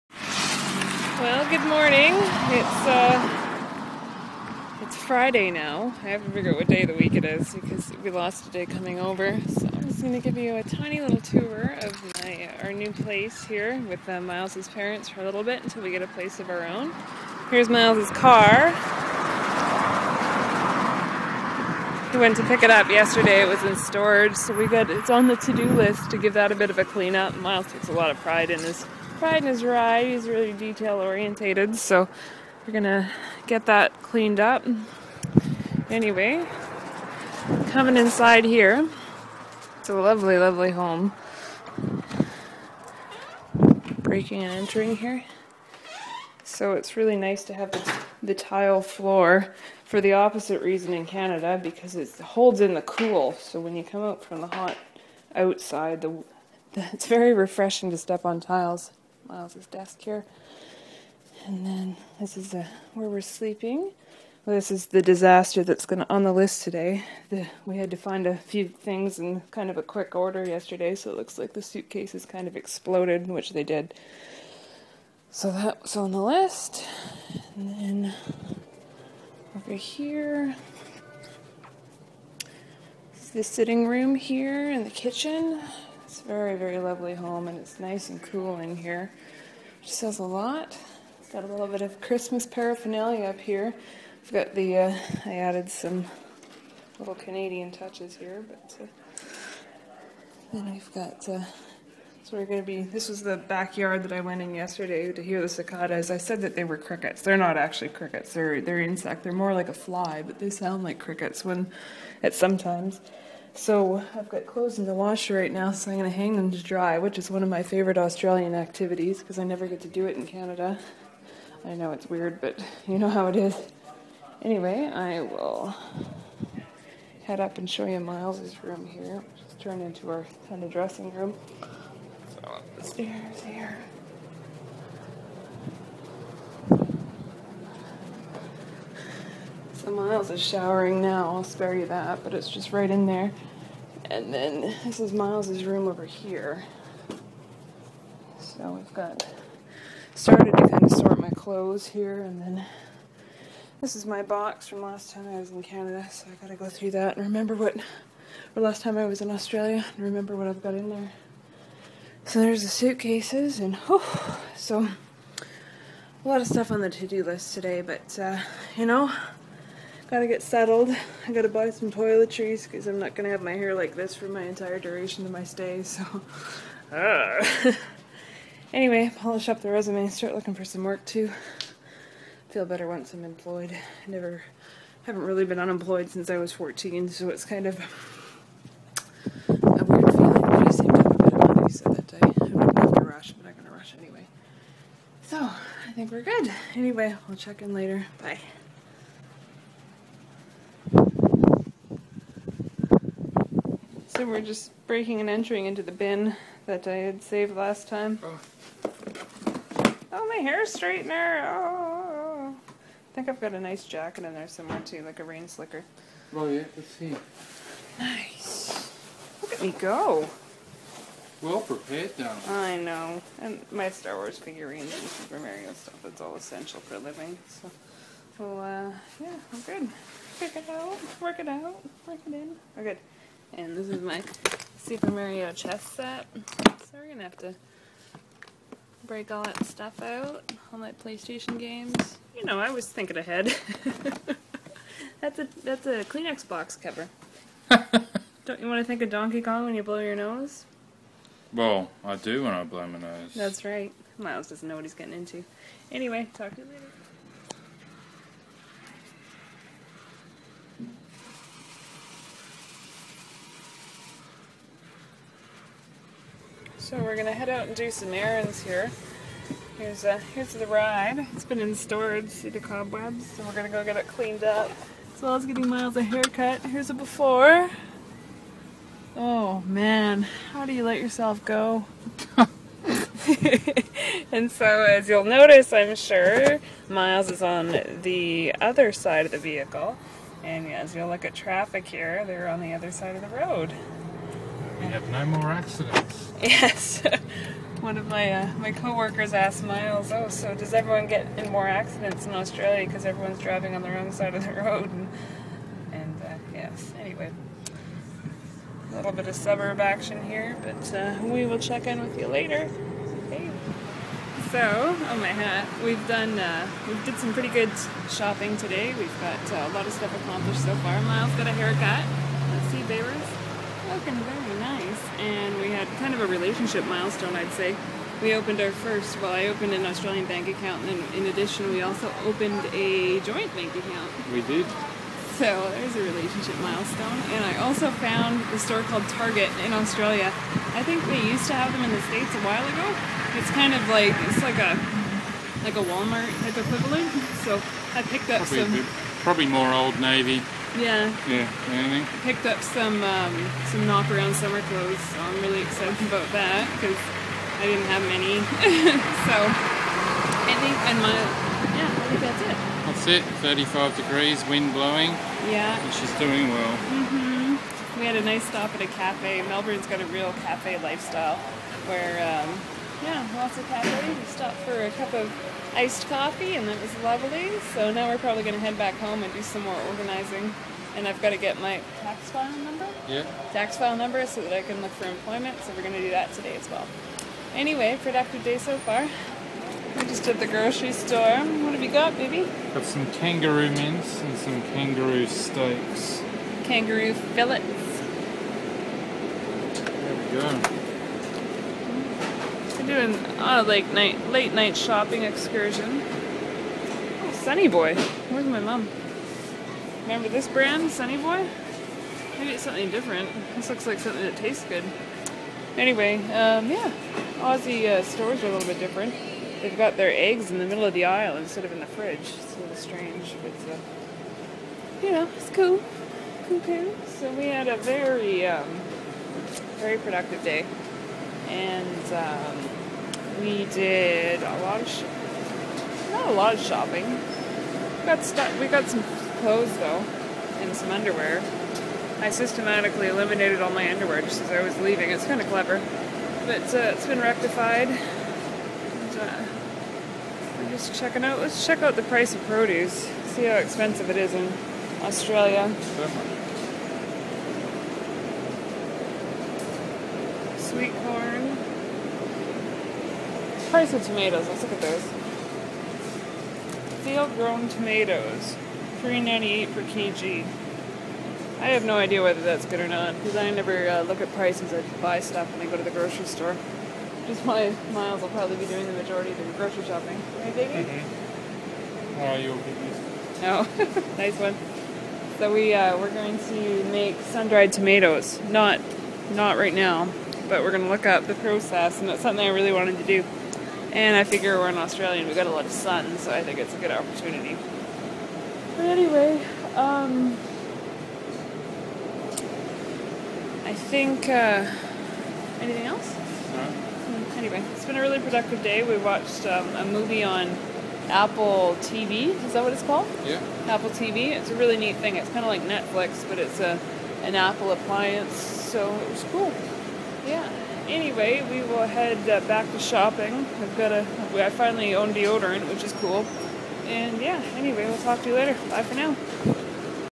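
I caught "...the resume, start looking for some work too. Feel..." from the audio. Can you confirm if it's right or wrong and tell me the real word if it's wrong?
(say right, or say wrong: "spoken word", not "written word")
right.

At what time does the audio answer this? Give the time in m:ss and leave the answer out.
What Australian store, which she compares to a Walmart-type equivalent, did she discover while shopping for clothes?
5:39.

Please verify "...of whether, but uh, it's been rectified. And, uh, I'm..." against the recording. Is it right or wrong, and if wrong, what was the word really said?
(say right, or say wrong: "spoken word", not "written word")
wrong: "clever", not "whether".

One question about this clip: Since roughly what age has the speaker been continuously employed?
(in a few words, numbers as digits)
14.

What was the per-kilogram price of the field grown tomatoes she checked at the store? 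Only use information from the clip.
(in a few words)
$3.98.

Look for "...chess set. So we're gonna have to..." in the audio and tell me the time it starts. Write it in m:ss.
3:55.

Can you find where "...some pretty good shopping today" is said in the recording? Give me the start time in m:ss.
5:17.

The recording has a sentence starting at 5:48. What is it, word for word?
Bit, probably more Old Navy yeah.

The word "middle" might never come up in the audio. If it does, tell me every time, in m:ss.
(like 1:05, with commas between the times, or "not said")
7:00.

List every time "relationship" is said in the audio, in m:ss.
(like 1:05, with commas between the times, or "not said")
5:26, 5:36.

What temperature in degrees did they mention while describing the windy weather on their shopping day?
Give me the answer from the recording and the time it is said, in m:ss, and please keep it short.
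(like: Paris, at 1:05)
35, at 6:03.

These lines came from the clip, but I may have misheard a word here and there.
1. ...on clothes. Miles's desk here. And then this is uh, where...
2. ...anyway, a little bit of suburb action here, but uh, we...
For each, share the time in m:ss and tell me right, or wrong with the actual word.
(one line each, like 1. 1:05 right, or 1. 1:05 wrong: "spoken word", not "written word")
1. 0:58 wrong: "tiles", not "clothes"
2. 5:06 right.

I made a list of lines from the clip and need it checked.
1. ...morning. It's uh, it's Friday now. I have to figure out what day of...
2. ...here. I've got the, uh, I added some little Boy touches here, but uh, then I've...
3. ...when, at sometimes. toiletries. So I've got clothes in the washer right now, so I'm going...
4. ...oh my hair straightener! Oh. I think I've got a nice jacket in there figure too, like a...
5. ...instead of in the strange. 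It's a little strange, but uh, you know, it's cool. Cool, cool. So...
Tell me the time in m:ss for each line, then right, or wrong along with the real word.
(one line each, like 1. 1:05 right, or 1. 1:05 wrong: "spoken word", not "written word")
1. 0:01 right
2. 1:33 wrong: "Canadian", not "Boy"
3. 1:51 wrong: "times", not "toiletries"
4. 3:30 wrong: "somewhere", not "figure"
5. 7:01 wrong: "fridge", not "strange".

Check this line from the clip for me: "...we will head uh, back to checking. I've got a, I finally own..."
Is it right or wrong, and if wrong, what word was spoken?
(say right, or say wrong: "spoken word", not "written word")
wrong: "shopping", not "checking".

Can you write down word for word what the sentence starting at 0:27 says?
Miles takes a lot of pride in his Pride in his ride.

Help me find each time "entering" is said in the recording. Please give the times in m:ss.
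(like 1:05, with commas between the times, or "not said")
0:44, 3:25.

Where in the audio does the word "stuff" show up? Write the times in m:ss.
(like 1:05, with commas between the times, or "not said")
2:46, 3:45, 3:59, 5:19, 7:55.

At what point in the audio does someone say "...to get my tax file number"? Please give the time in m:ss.
6:21.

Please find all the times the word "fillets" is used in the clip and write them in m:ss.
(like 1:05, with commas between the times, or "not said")
6:37.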